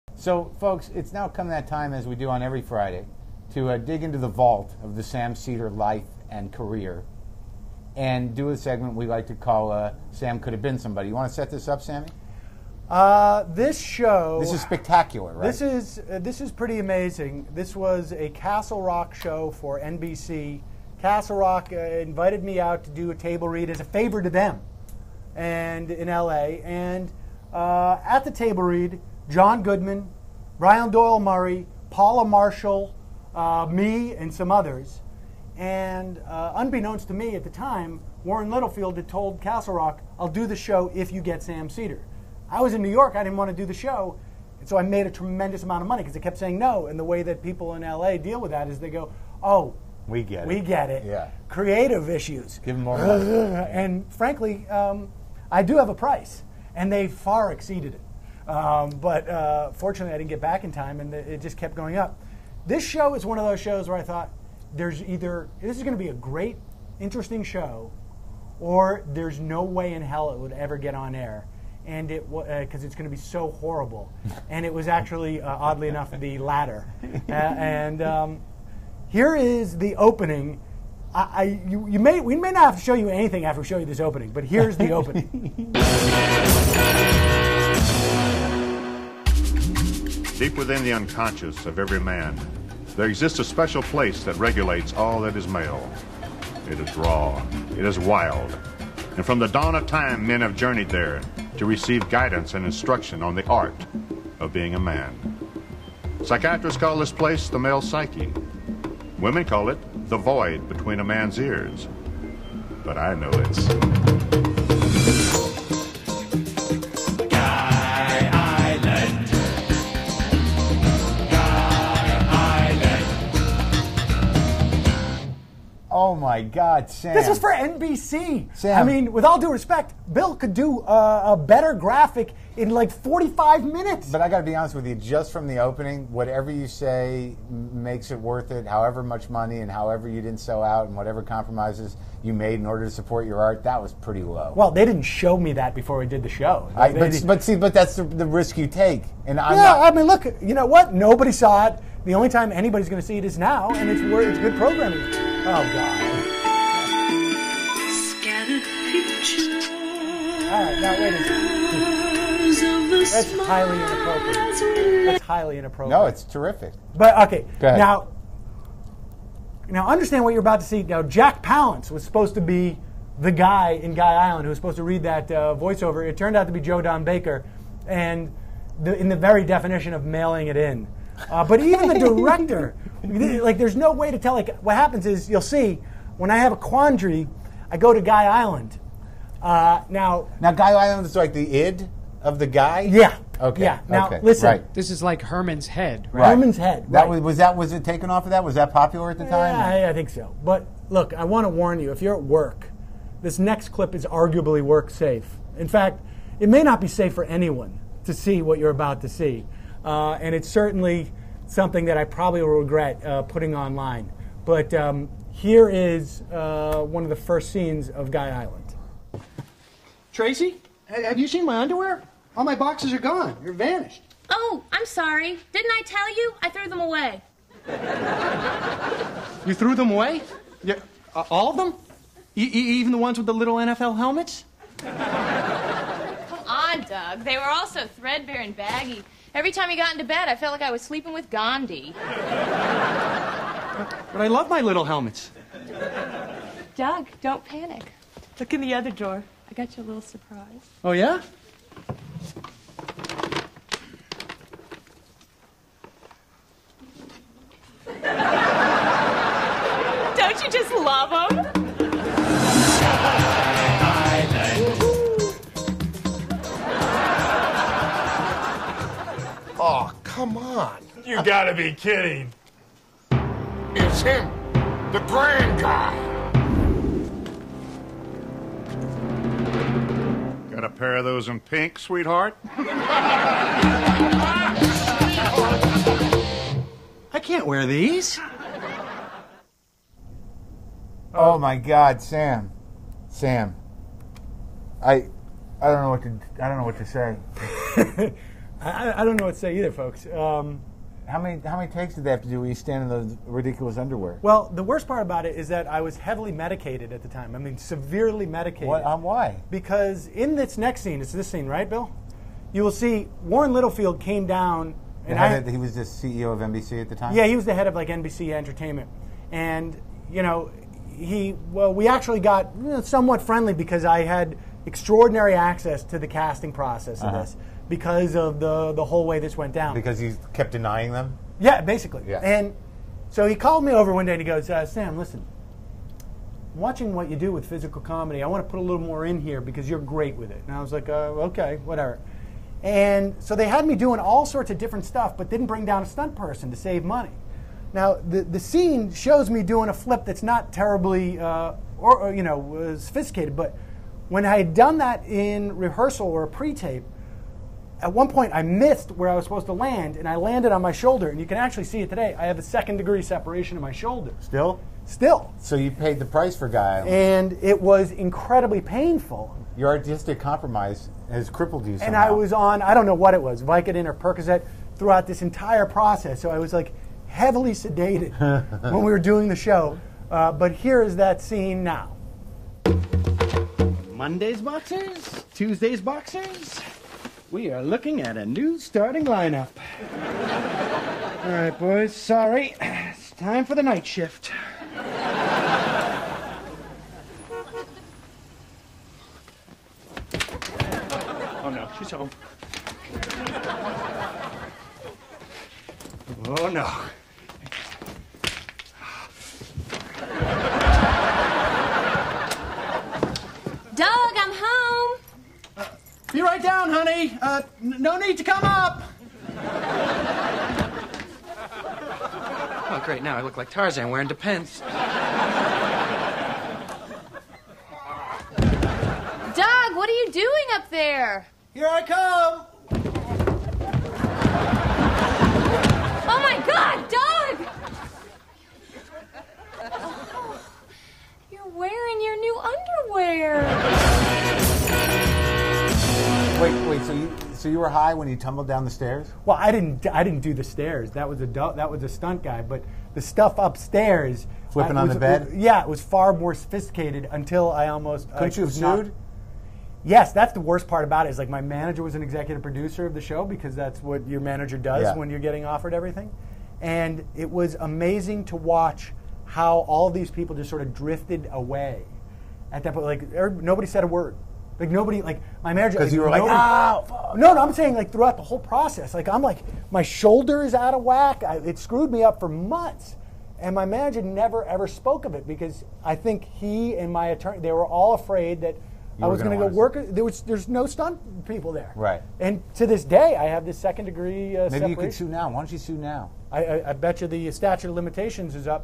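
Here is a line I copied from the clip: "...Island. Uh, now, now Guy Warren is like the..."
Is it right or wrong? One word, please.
wrong.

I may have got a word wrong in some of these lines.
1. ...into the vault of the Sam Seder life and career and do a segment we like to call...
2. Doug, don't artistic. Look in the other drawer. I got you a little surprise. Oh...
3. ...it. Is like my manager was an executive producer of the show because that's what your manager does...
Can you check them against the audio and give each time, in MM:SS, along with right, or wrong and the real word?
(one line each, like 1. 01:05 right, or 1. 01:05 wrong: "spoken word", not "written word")
1. 00:04 right
2. 04:06 wrong: "panic", not "artistic"
3. 07:41 right.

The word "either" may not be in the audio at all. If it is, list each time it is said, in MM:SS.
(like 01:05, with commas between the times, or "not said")
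01:05, 04:59.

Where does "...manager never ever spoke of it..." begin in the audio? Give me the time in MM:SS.
08:03.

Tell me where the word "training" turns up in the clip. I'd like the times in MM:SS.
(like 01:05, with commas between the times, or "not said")
not said.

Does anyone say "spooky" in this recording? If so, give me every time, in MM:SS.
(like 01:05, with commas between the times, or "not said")
not said.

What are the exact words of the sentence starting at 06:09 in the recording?
Your artistic compromise has crippled you somehow.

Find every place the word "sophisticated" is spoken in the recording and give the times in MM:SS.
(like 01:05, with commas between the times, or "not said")
05:52, 07:36.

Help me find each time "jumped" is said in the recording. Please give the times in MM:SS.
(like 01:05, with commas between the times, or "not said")
not said.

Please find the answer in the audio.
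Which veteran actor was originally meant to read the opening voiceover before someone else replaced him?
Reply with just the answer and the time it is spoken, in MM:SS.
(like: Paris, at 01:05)
Jack Palance, at 02:51.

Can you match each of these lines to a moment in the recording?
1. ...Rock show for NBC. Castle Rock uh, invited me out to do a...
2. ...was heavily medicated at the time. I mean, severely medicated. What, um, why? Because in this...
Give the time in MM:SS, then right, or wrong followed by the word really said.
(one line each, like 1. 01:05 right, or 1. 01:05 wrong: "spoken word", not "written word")
1. 00:18 right
2. 05:05 right.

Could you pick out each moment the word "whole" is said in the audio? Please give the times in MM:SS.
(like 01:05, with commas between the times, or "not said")
05:28, 07:58.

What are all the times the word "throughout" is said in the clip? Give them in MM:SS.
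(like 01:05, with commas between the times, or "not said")
06:14, 07:57.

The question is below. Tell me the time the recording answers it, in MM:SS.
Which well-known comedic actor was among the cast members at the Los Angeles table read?
00:29.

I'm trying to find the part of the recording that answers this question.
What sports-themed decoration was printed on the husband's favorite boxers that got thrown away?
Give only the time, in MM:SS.
03:53.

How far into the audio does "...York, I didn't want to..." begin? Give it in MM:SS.
00:42.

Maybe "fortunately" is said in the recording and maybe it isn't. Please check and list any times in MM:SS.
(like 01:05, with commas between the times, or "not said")
00:59.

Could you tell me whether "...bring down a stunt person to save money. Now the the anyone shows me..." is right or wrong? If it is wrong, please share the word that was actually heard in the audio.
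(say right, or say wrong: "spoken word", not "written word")
wrong: "scene", not "anyone".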